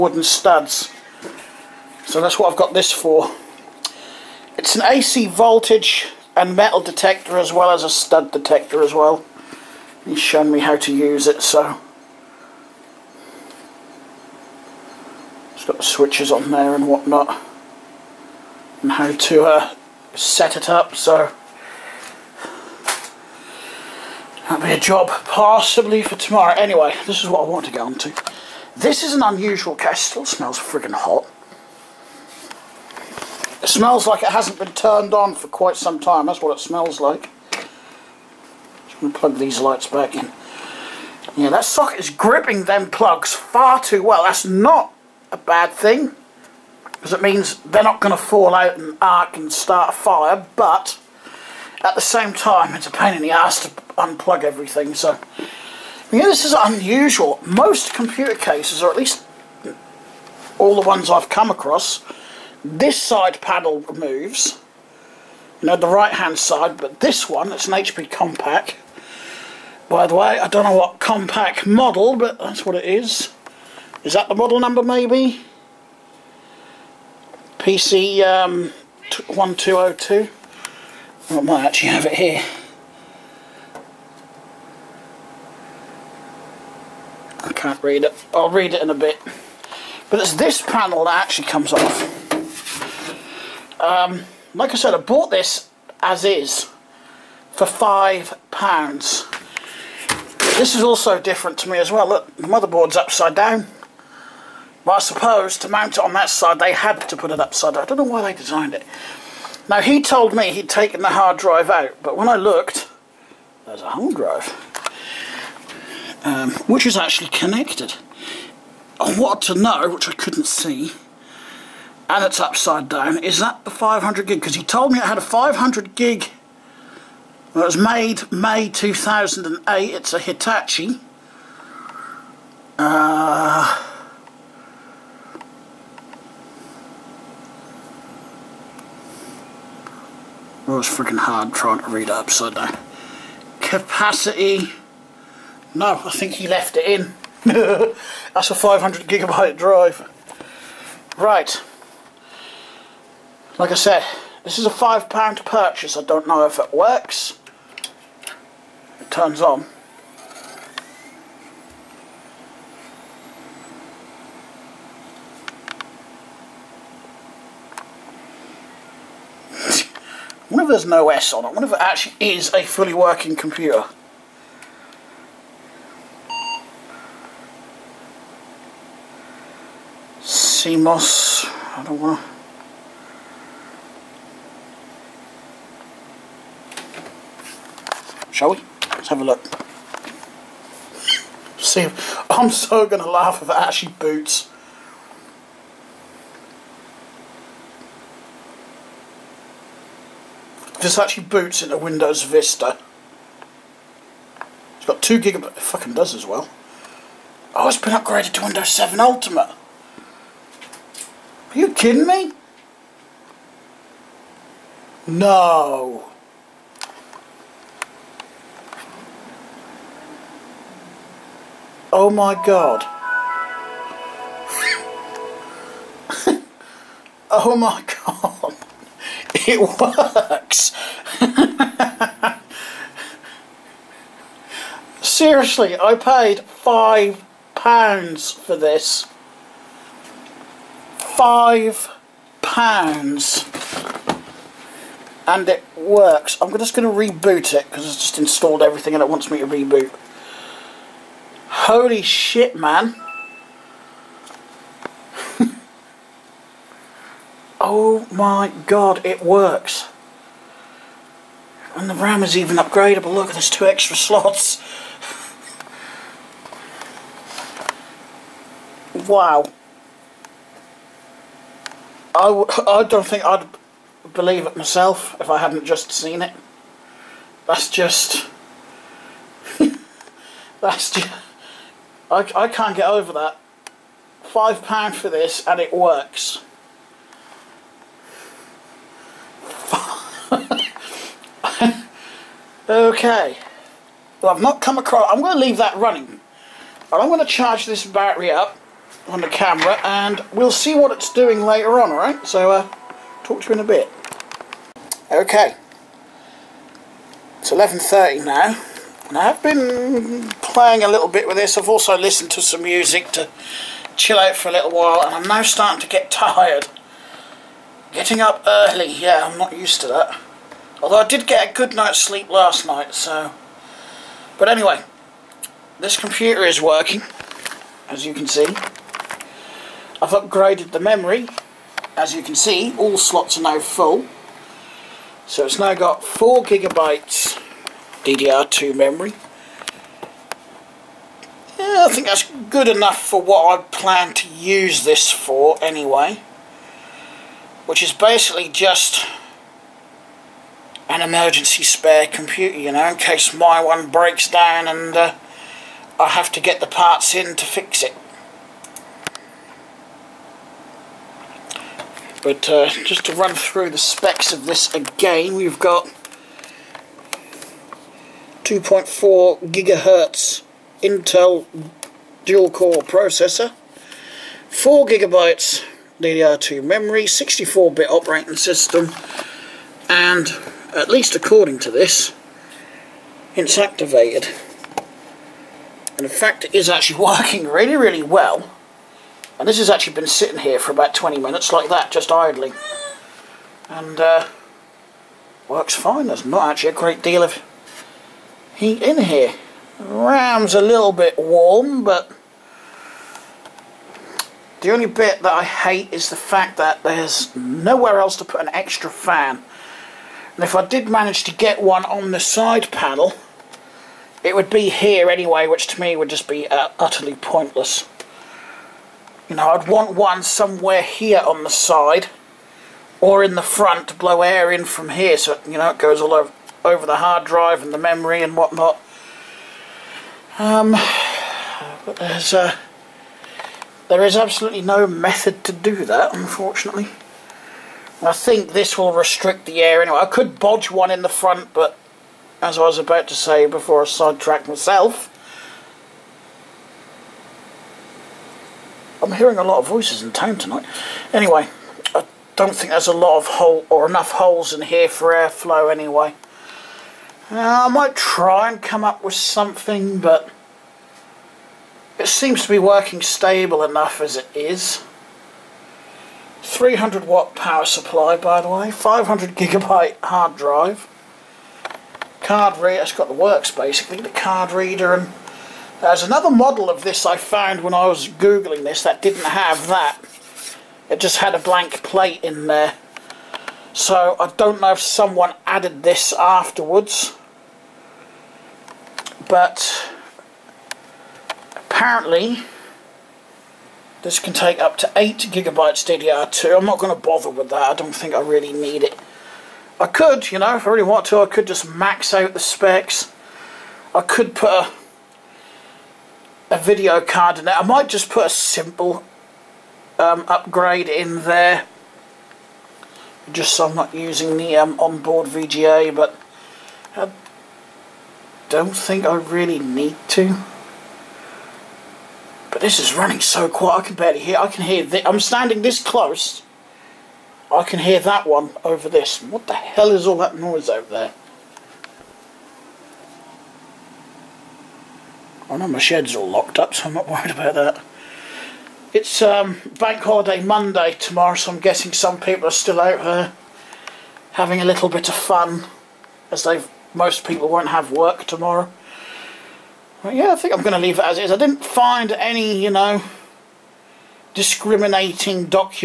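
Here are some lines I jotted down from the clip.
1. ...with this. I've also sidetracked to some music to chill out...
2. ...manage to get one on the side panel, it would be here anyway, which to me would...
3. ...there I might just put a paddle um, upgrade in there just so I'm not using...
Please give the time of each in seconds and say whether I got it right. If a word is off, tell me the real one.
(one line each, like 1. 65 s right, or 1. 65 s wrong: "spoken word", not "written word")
1. 311 s wrong: "listened", not "sidetracked"
2. 410 s right
3. 507 s wrong: "simple", not "paddle".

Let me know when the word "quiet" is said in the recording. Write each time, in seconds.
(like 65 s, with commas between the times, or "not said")
523 s.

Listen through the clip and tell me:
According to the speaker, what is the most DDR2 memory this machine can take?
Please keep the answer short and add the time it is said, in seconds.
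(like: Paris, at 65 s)
8 gigabytes, at 494 s.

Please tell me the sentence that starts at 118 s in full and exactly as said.
I wanted to know, which I couldn't see, and it's upside down.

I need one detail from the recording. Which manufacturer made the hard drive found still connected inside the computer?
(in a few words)
Hitachi.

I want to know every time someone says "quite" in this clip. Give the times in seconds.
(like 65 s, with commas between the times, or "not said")
35 s.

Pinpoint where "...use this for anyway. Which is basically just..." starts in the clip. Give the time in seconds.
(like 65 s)
344 s.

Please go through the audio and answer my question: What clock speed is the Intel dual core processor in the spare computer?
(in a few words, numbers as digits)
2.4 gigahertz.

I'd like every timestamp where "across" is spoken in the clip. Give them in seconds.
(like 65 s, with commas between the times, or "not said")
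61 s, 294 s.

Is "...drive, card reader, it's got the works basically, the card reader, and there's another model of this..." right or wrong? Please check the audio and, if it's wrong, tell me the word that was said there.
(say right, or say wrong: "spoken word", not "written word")
right.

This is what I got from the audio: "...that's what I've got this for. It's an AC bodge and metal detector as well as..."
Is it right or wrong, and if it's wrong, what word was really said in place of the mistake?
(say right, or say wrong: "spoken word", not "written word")
wrong: "voltage", not "bodge".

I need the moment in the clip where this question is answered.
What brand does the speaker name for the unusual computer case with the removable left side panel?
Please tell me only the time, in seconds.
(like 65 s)
67 s.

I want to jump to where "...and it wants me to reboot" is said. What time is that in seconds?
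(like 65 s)
248 s.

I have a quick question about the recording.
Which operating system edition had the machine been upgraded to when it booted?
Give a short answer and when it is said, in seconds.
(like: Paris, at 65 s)
Windows 7 Ultimate, at 208 s.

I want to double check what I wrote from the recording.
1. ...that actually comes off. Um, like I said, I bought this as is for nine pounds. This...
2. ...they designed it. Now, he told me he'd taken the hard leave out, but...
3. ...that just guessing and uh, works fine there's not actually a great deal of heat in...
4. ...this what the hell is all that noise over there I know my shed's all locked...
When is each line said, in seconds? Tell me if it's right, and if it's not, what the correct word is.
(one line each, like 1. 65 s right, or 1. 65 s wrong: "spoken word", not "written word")
1. 91 s wrong: "five", not "nine"
2. 108 s wrong: "drive", not "leave"
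3. 391 s wrong: "idling", not "guessing"
4. 528 s right.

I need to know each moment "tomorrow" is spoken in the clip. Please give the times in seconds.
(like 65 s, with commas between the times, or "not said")
26 s, 540 s, 548 s.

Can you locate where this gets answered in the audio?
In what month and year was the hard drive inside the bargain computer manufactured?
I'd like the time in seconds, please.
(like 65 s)
128 s.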